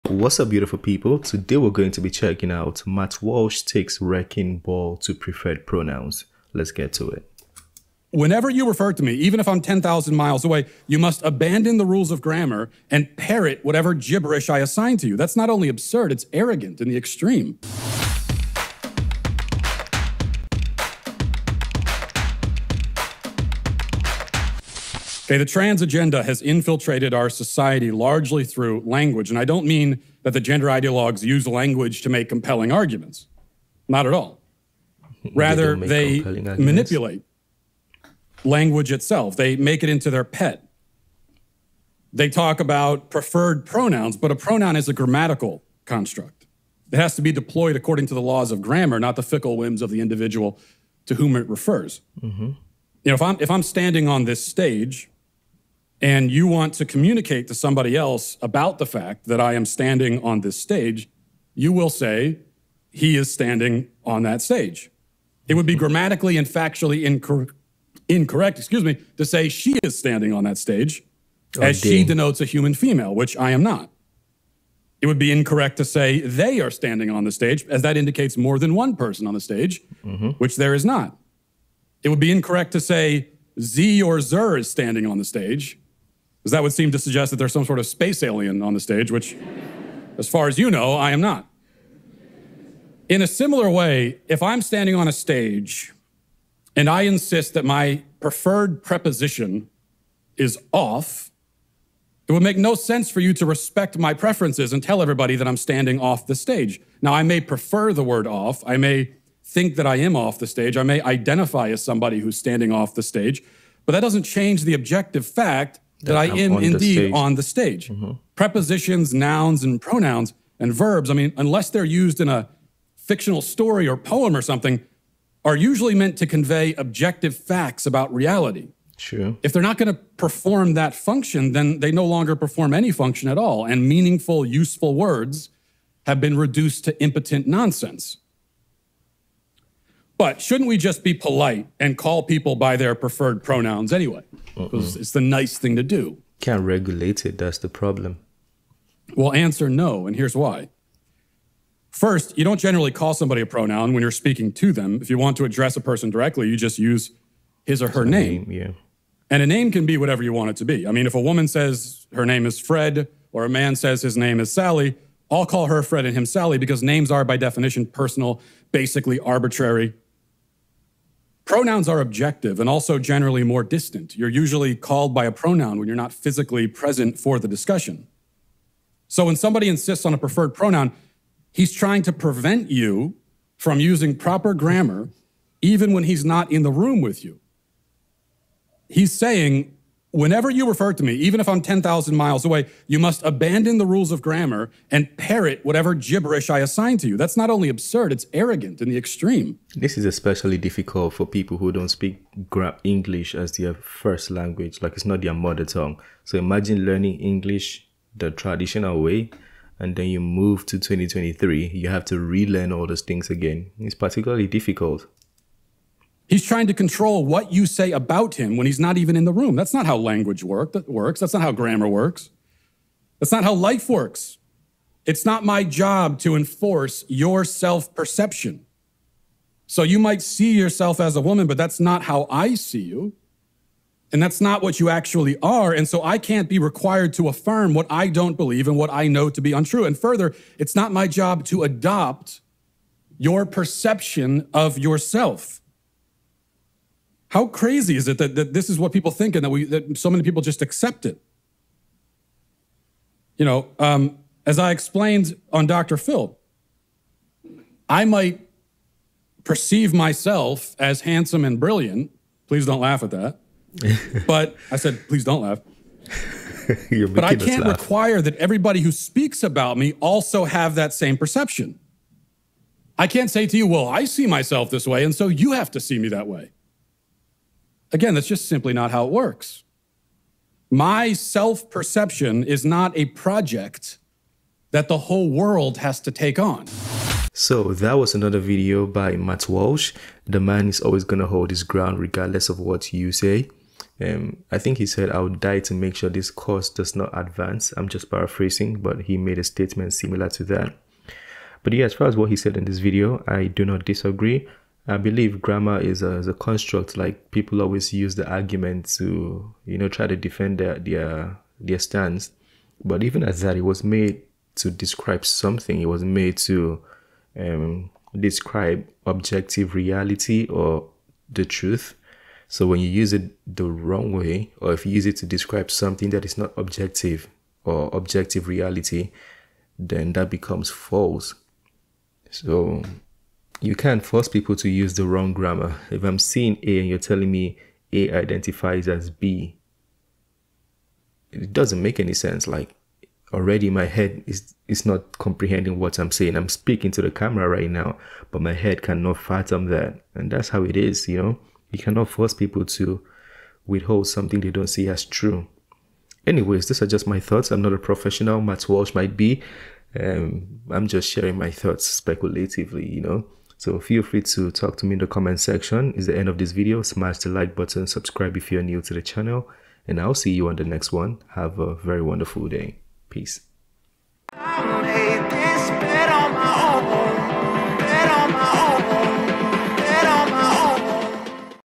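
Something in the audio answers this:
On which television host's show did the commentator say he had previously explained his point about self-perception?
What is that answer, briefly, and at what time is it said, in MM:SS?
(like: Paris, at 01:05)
Dr. Phil, at 04:15.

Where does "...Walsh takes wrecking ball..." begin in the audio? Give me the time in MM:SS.
00:03.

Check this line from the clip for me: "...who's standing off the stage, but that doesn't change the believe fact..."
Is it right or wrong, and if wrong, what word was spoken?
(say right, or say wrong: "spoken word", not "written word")
wrong: "objective", not "believe".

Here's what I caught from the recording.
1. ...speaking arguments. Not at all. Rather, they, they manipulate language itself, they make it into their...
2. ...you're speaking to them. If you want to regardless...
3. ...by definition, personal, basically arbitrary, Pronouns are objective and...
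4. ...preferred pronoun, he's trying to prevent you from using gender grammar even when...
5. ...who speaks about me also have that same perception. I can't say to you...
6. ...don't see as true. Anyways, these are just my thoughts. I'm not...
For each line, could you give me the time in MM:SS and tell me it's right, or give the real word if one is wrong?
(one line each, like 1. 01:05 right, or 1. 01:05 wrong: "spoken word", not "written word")
1. 00:32 wrong: "compelling", not "speaking"
2. 02:34 wrong: "address", not "regardless"
3. 02:47 right
4. 03:00 wrong: "proper", not "gender"
5. 04:28 right
6. 05:54 right.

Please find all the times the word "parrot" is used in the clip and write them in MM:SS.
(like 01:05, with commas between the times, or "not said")
00:13, 03:15.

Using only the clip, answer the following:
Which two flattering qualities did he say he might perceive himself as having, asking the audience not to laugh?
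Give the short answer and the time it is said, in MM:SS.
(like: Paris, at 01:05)
handsome and brilliant, at 04:21.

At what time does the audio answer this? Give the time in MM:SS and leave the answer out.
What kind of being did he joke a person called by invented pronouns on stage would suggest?
01:27.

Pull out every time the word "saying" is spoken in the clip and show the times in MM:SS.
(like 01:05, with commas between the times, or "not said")
03:09, 05:46.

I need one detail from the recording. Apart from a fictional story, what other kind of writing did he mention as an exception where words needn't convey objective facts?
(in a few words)
poem.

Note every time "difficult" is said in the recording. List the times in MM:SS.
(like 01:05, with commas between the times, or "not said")
03:20, 03:34.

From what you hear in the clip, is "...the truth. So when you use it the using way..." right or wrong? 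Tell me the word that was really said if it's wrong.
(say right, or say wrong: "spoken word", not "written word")
wrong: "wrong", not "using".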